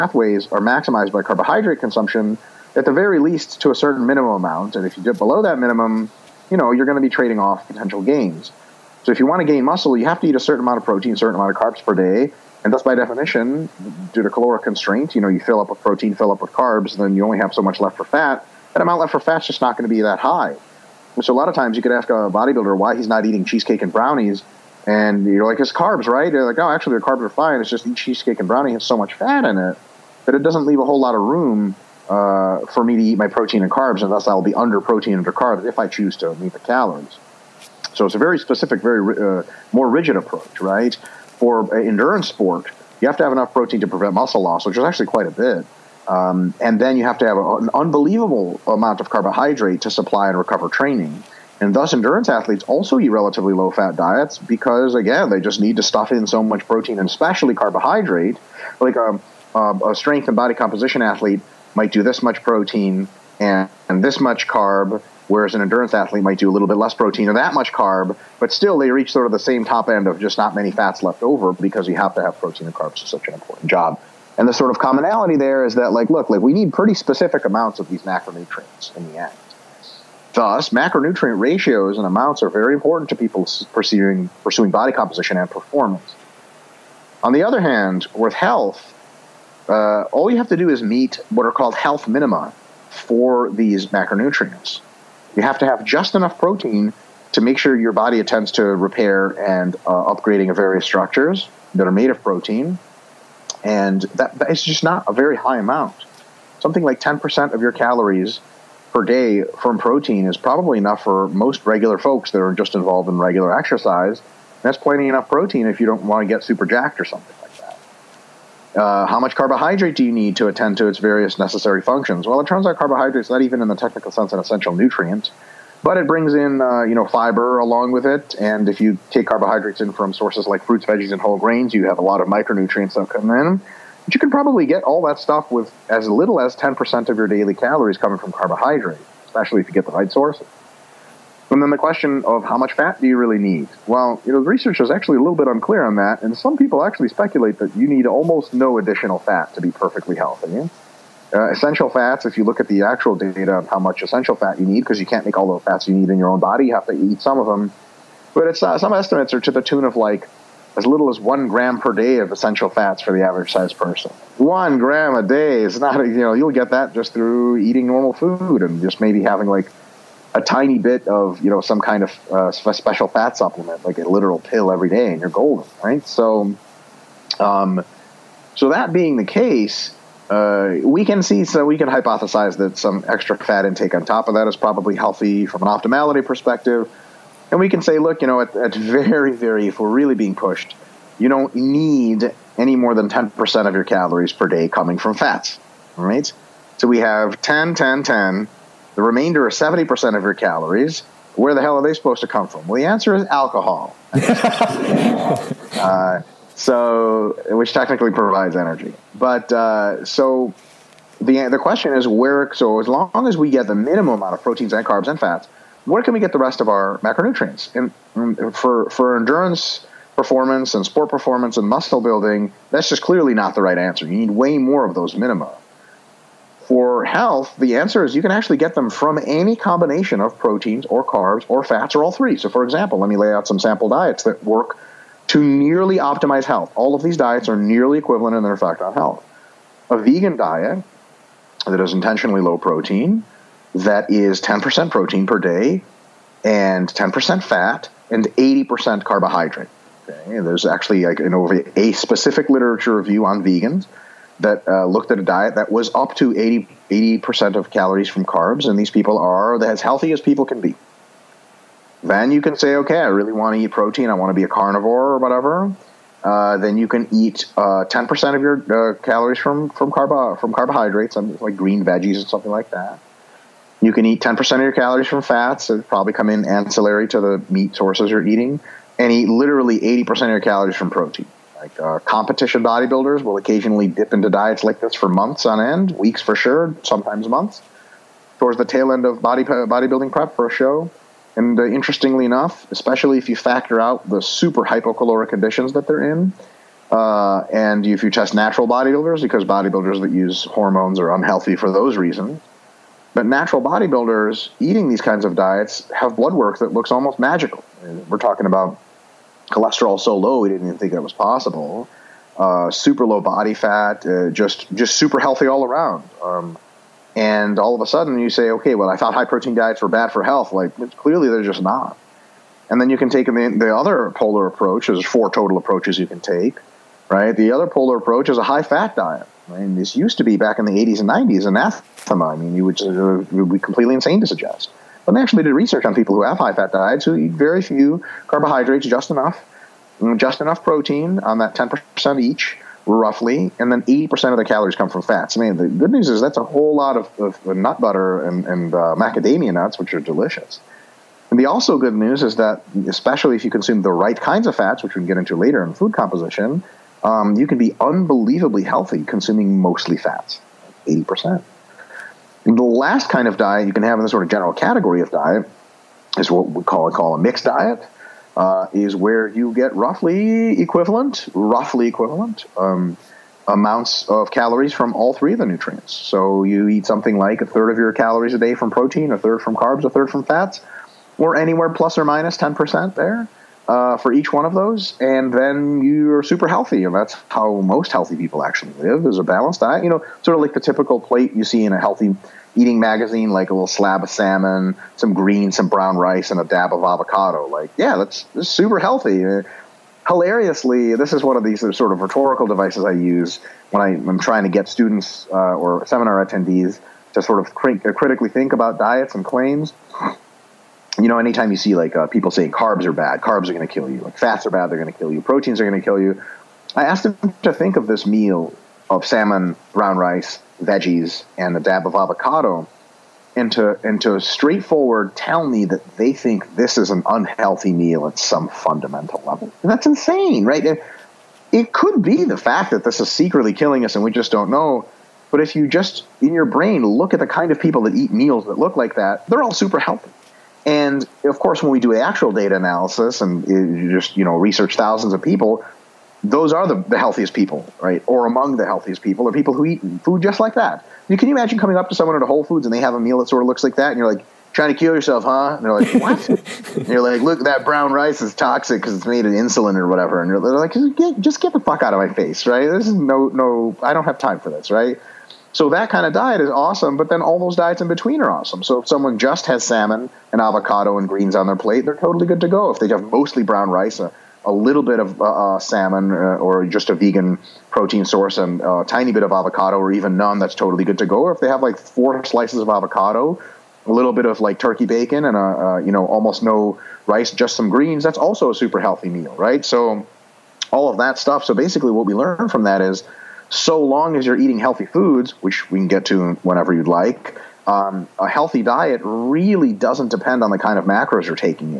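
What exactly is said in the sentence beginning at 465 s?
So that kind of diet is awesome, but then all those diets in between are awesome.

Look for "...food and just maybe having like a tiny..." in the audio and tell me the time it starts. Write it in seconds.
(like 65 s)
168 s.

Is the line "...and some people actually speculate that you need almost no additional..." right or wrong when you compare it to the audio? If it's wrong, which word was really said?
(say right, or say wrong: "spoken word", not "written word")
right.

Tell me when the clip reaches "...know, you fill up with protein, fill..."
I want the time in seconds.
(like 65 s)
15 s.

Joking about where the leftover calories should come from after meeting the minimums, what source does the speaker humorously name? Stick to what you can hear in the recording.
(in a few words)
alcohol.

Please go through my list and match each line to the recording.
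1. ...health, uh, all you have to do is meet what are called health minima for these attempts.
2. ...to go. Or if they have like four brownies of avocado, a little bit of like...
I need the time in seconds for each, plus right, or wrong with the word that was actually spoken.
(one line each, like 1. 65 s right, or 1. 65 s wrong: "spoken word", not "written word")
1. 88 s wrong: "macronutrients", not "attempts"
2. 480 s wrong: "slices", not "brownies".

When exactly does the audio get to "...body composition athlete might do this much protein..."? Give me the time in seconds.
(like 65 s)
60 s.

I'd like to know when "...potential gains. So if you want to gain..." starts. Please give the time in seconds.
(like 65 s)
7 s.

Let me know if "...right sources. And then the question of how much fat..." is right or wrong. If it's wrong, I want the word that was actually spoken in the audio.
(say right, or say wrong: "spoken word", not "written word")
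right.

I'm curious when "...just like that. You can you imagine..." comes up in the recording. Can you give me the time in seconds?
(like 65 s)
450 s.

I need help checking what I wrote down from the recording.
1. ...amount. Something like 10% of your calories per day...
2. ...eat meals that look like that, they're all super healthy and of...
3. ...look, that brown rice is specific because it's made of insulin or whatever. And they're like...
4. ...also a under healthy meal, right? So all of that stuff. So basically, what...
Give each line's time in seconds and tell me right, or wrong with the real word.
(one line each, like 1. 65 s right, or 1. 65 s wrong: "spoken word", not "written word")
1. 105 s right
2. 437 s right
3. 457 s wrong: "toxic", not "specific"
4. 488 s wrong: "super", not "under".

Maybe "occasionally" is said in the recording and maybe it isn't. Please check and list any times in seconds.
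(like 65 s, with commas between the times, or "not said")
283 s.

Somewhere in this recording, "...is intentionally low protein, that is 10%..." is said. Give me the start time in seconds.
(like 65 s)
241 s.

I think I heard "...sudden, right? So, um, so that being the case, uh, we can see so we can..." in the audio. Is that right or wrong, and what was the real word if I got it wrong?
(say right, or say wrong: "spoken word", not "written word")
wrong: "golden", not "sudden".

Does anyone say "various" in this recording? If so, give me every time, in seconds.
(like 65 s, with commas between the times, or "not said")
100 s, 120 s.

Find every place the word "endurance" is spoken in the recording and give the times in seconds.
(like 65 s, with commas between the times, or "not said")
41 s, 51 s, 65 s, 219 s.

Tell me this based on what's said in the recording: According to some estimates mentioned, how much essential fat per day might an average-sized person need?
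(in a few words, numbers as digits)
1 gram.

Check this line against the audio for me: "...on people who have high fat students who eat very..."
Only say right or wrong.
wrong.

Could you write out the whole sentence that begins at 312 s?
Uh, super low body fat, uh, just just super healthy all around.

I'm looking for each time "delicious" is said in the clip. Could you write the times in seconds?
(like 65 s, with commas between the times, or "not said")
349 s.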